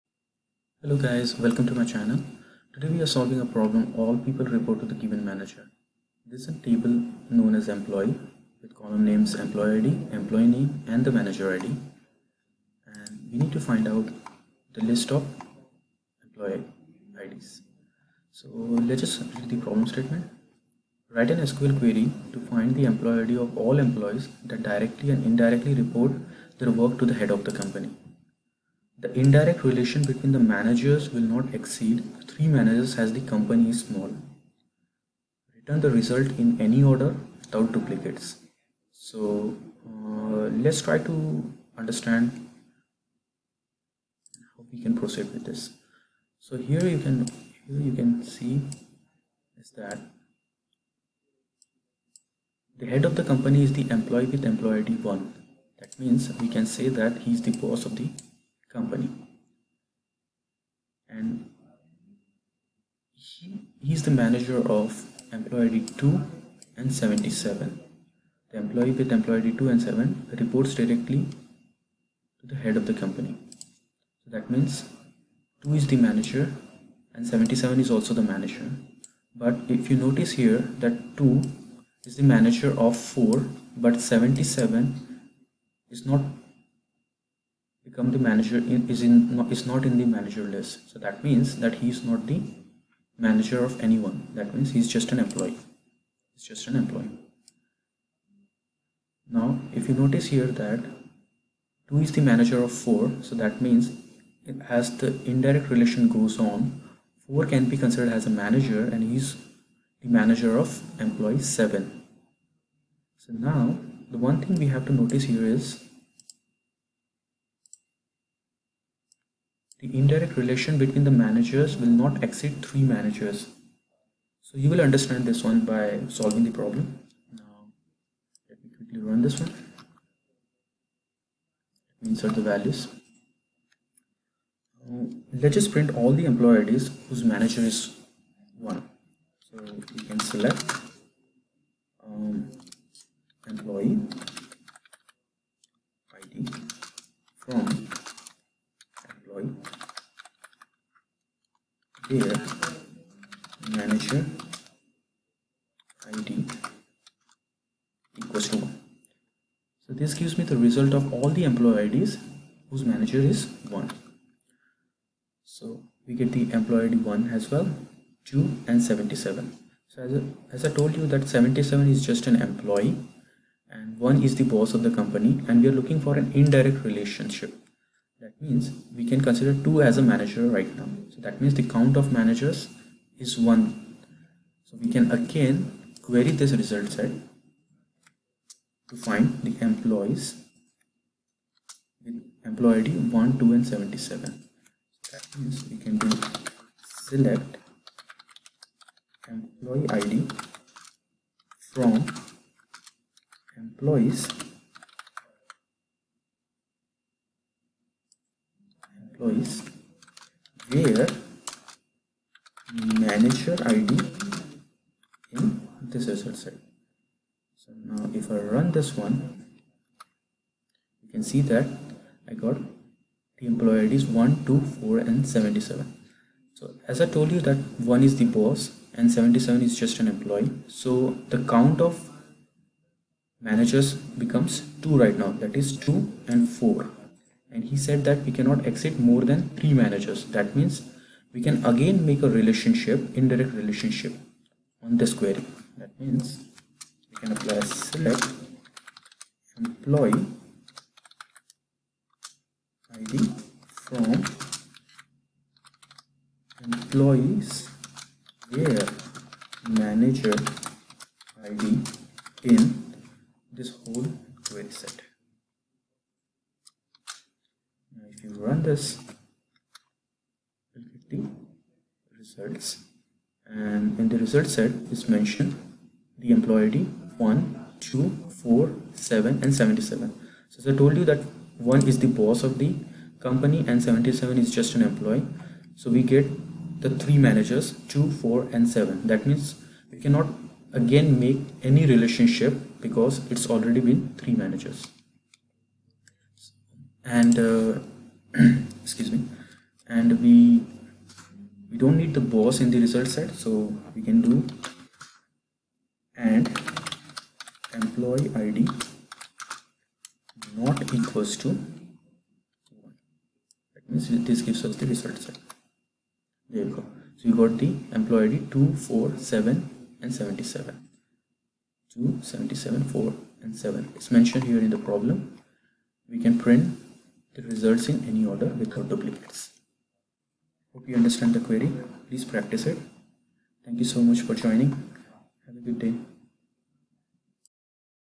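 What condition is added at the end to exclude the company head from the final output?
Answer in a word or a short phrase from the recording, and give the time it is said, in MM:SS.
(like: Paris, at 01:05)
employee id not equals to 1, at 05:07.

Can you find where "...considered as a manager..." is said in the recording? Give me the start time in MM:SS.
01:47.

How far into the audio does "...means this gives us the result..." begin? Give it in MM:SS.
05:13.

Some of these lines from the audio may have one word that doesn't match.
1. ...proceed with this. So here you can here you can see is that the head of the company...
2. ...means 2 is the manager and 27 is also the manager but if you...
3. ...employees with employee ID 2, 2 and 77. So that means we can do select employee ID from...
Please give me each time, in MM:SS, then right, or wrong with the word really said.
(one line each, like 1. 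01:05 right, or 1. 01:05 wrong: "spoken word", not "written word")
1. 00:44 right
2. 01:14 wrong: "77", not "27"
3. 03:09 wrong: "1", not "2".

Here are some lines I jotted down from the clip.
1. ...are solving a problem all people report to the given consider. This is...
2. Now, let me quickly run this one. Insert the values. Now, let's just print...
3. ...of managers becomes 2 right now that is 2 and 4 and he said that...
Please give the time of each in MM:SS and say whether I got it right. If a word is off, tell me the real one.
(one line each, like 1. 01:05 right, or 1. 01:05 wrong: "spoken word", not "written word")
1. 00:03 wrong: "manager", not "consider"
2. 02:07 right
3. 03:51 right.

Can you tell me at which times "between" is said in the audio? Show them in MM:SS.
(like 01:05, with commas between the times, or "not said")
00:30, 02:00.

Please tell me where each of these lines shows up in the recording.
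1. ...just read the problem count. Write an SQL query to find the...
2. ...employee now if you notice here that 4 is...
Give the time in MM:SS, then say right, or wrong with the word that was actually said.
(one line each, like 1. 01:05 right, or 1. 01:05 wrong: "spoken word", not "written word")
1. 00:19 wrong: "statement", not "count"
2. 01:36 wrong: "2", not "4".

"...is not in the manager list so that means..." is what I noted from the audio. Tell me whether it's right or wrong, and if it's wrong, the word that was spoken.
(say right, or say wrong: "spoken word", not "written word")
right.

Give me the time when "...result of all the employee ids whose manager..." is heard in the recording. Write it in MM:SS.
02:40.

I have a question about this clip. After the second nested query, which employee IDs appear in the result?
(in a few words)
1, 2, 4 and 77.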